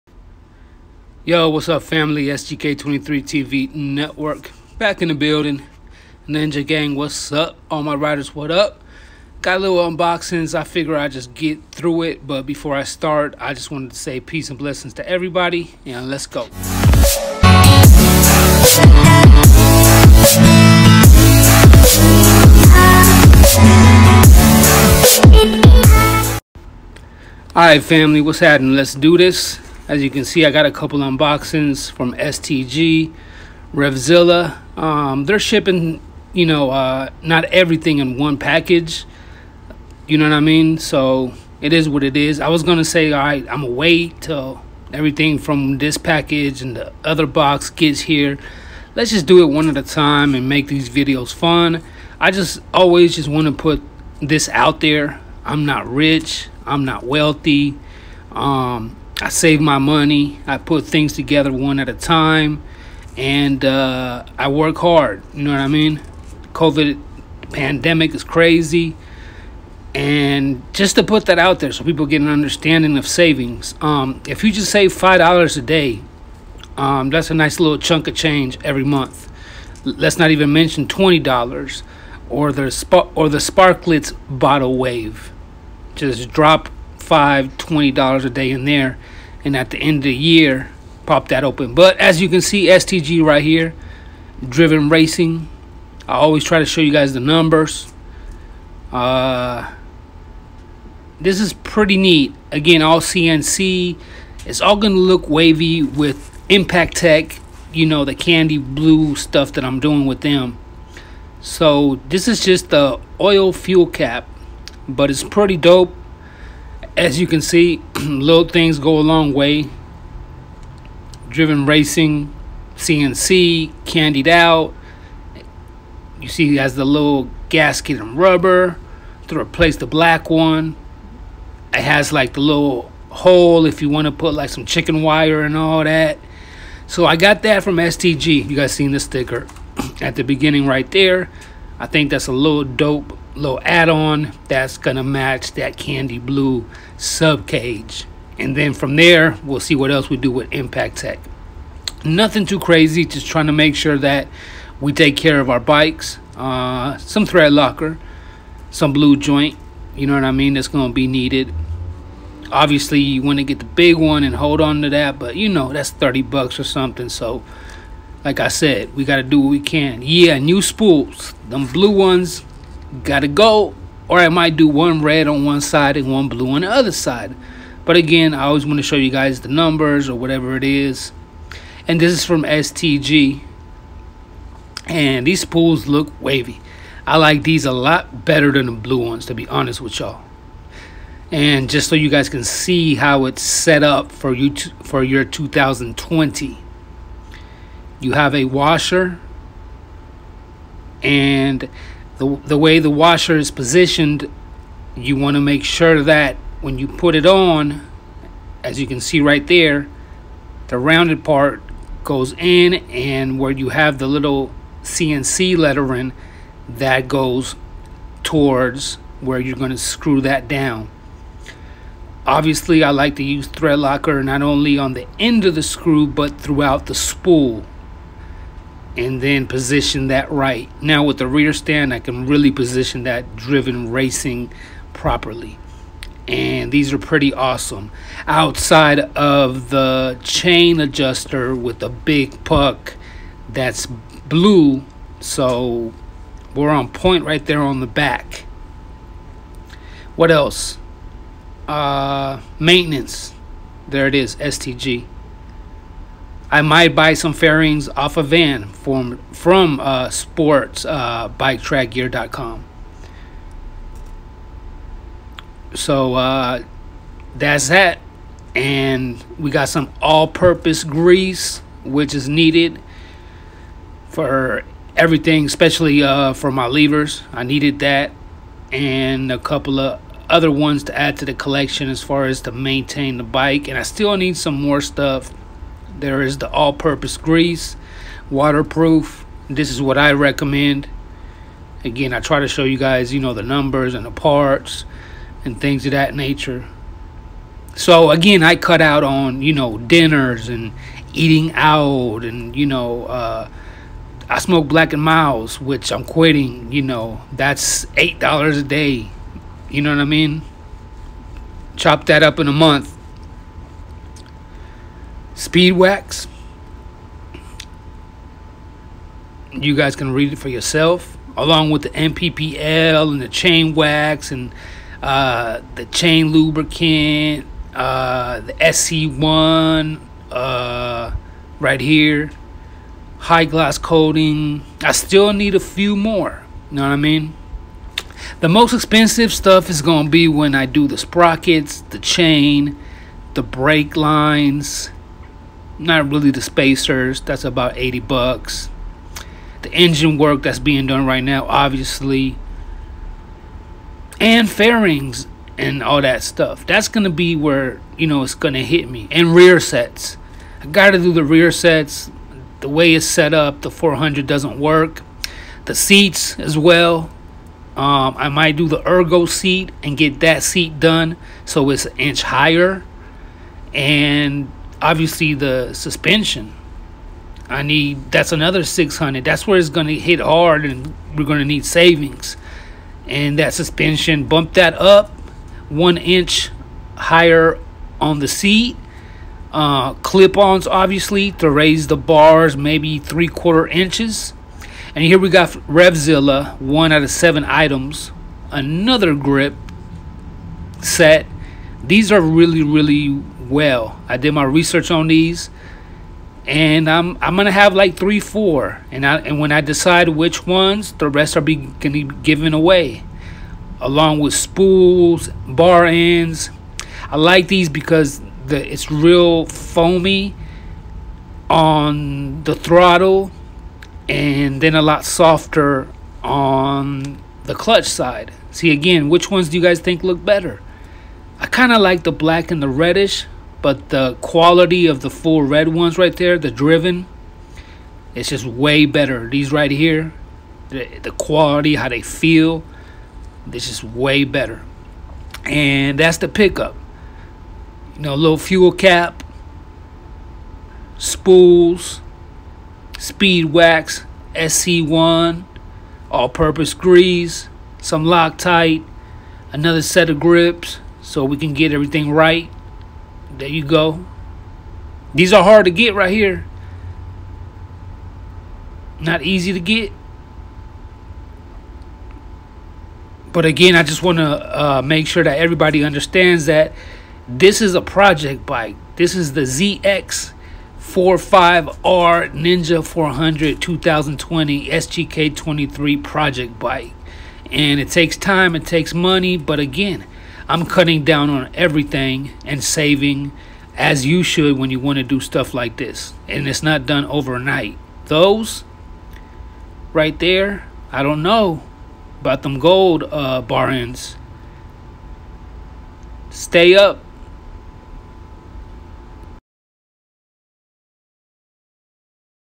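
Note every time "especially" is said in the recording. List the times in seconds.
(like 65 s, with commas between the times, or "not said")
275 s.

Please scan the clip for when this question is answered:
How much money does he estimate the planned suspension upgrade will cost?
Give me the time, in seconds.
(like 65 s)
378 s.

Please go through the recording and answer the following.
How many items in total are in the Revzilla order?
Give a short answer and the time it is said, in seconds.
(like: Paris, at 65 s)
7, at 397 s.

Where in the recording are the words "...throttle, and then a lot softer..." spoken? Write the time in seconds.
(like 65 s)
422 s.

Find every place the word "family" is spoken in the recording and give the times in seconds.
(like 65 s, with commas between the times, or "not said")
1 s, 27 s.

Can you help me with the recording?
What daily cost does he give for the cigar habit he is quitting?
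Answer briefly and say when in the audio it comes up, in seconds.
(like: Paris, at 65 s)
$8, at 307 s.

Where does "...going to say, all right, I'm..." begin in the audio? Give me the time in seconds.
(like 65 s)
42 s.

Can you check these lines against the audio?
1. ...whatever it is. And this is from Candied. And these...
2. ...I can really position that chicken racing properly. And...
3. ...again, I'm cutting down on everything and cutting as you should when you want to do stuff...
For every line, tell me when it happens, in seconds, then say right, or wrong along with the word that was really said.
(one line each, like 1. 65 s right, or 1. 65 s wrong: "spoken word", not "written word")
1. 180 s wrong: "STG", not "Candied"
2. 231 s wrong: "driven", not "chicken"
3. 489 s wrong: "saving", not "cutting".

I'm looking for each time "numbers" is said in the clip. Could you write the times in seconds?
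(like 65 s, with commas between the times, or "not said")
97 s, 179 s, 293 s.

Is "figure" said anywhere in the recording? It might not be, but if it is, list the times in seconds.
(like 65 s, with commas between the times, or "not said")
10 s.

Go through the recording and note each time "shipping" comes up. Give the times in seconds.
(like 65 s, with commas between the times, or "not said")
35 s.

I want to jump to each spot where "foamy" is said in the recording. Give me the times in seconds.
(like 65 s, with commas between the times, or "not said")
419 s.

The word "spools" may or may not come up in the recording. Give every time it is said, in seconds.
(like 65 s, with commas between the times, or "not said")
170 s, 226 s, 414 s, 450 s.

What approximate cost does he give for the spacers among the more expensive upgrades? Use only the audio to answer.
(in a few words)
$80.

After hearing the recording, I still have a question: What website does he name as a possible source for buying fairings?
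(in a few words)
sportsbiketrackgear.com.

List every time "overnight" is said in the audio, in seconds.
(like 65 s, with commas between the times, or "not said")
497 s.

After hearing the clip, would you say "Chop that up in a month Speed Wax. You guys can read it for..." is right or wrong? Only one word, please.
right.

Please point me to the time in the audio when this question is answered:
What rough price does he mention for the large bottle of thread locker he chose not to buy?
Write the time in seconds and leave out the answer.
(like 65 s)
165 s.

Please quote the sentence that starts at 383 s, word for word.
And that suspension bump that up 1 inch higher on the seat.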